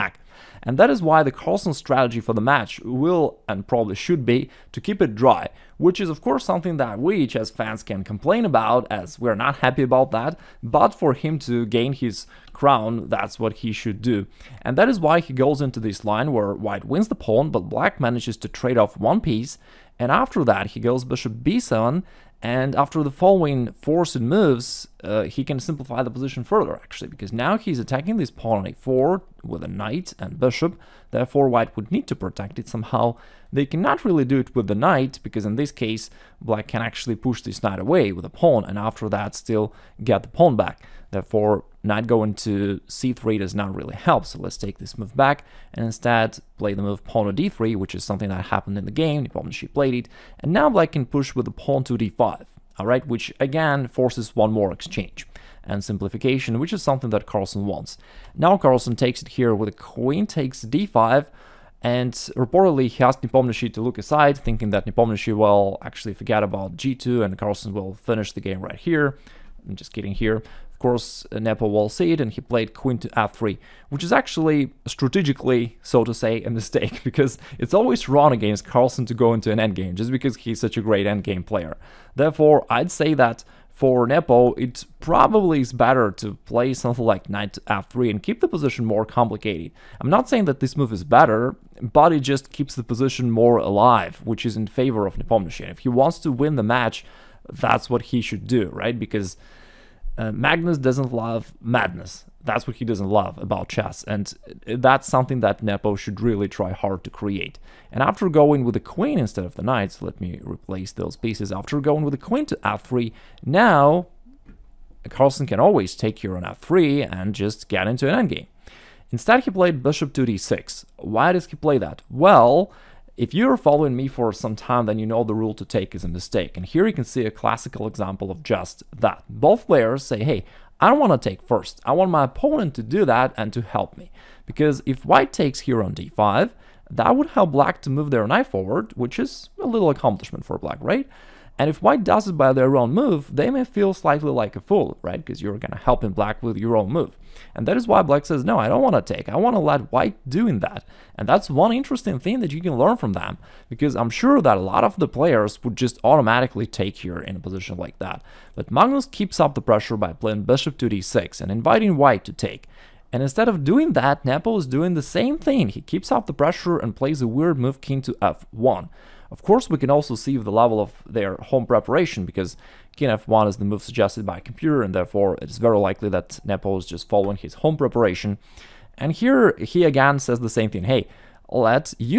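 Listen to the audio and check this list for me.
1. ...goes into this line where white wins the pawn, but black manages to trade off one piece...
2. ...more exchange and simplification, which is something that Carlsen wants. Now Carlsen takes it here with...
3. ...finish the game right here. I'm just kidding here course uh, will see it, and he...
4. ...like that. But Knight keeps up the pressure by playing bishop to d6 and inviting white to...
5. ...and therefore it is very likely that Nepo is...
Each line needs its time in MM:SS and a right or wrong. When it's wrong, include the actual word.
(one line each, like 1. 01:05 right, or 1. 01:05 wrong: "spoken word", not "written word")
1. 00:15 right
2. 00:54 right
3. 01:07 right
4. 02:37 wrong: "Magnus", not "Knight"
5. 02:54 right.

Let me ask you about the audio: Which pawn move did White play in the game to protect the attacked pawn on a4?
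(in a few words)
d3.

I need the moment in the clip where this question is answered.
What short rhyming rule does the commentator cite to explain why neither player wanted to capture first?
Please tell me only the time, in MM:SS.
02:05.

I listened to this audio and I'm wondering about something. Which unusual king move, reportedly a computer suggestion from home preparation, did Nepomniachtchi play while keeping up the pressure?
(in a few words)
King to f1.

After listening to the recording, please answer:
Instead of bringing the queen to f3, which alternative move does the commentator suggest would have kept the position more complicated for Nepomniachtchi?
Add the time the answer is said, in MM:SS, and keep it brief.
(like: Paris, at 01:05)
Knight f3, at 01:27.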